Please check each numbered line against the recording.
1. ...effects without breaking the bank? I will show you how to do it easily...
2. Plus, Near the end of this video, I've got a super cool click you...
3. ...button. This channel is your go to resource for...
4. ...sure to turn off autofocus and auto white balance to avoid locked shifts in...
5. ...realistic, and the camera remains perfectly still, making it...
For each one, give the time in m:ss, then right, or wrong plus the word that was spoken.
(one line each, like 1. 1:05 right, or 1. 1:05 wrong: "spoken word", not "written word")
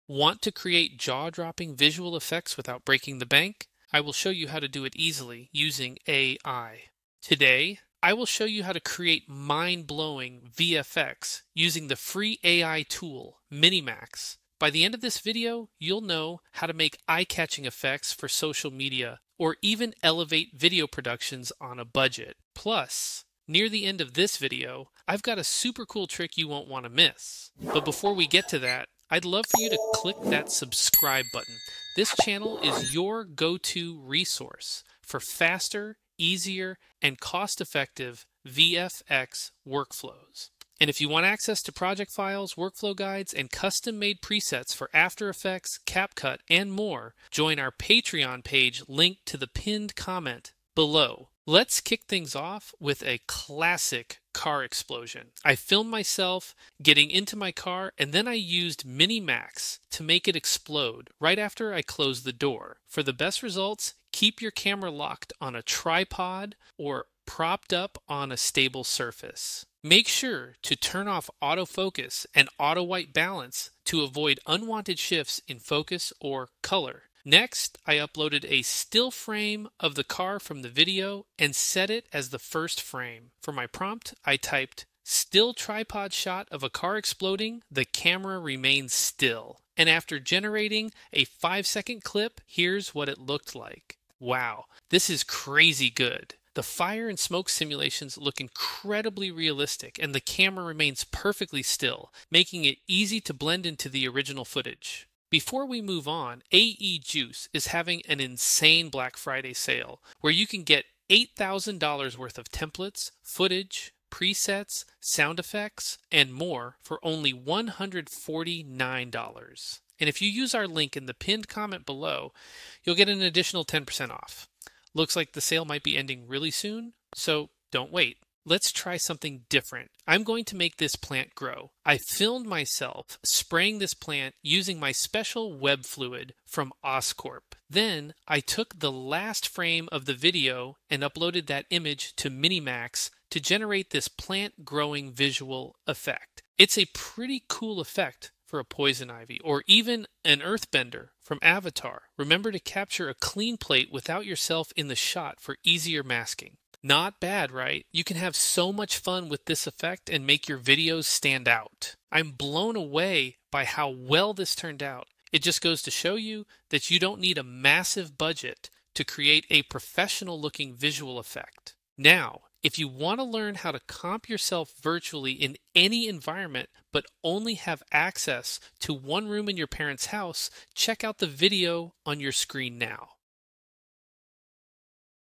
1. 0:02 right
2. 0:22 wrong: "trick", not "click"
3. 0:31 right
4. 1:10 wrong: "unwanted", not "locked"
5. 1:39 right.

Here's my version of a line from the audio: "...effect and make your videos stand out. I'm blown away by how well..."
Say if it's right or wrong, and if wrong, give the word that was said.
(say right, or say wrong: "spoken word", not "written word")
right.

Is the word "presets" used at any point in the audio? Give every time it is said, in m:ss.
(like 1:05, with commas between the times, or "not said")
0:44, 1:54.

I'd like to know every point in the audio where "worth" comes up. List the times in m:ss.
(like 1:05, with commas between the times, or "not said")
1:52.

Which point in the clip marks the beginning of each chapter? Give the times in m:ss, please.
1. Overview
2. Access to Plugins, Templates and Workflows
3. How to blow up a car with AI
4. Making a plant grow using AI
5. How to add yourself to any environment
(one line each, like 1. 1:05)
1. 0:11
2. 0:41
3. 0:52
4. 2:08
5. 2:52.